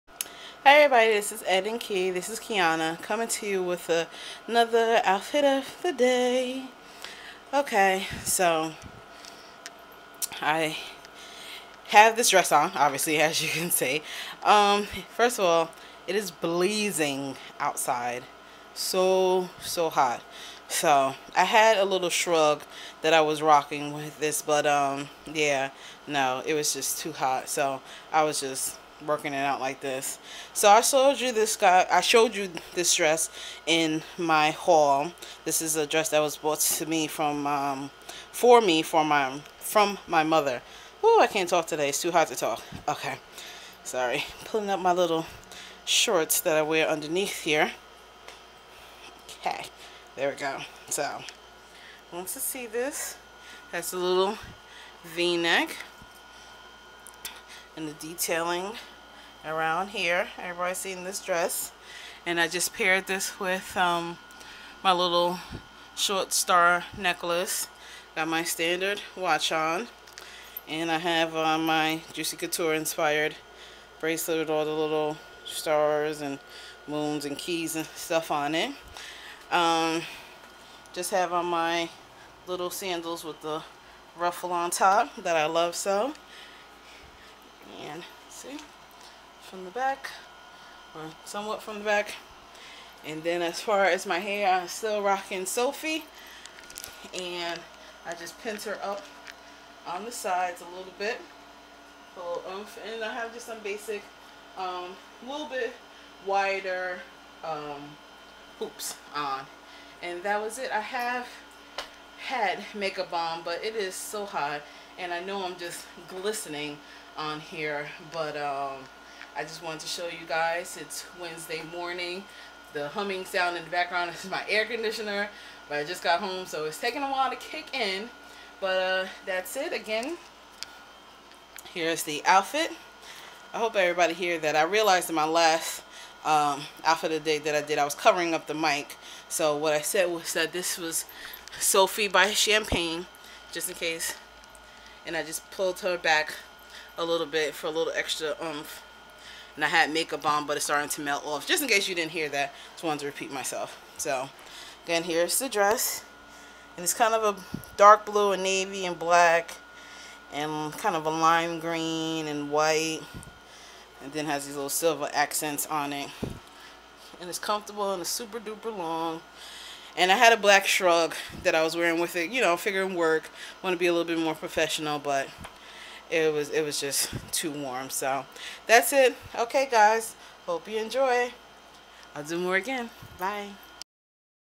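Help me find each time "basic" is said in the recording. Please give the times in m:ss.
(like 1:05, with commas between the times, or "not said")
1:43.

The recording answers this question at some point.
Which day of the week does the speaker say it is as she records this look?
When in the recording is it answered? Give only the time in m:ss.
2:01.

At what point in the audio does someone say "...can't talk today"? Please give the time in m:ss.
0:41.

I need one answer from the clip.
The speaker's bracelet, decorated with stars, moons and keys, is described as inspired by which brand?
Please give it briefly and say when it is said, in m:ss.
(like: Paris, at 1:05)
Juicy Couture, at 1:12.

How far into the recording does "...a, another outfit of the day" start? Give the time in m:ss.
0:03.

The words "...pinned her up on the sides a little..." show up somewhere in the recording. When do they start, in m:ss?
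1:38.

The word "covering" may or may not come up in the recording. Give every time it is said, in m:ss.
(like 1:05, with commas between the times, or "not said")
2:17.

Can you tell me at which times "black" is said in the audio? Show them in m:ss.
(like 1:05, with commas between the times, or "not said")
2:38, 2:50.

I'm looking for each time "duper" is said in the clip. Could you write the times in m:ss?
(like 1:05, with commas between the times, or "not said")
2:48.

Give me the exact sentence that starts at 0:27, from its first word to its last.
So, I was just working it out like this.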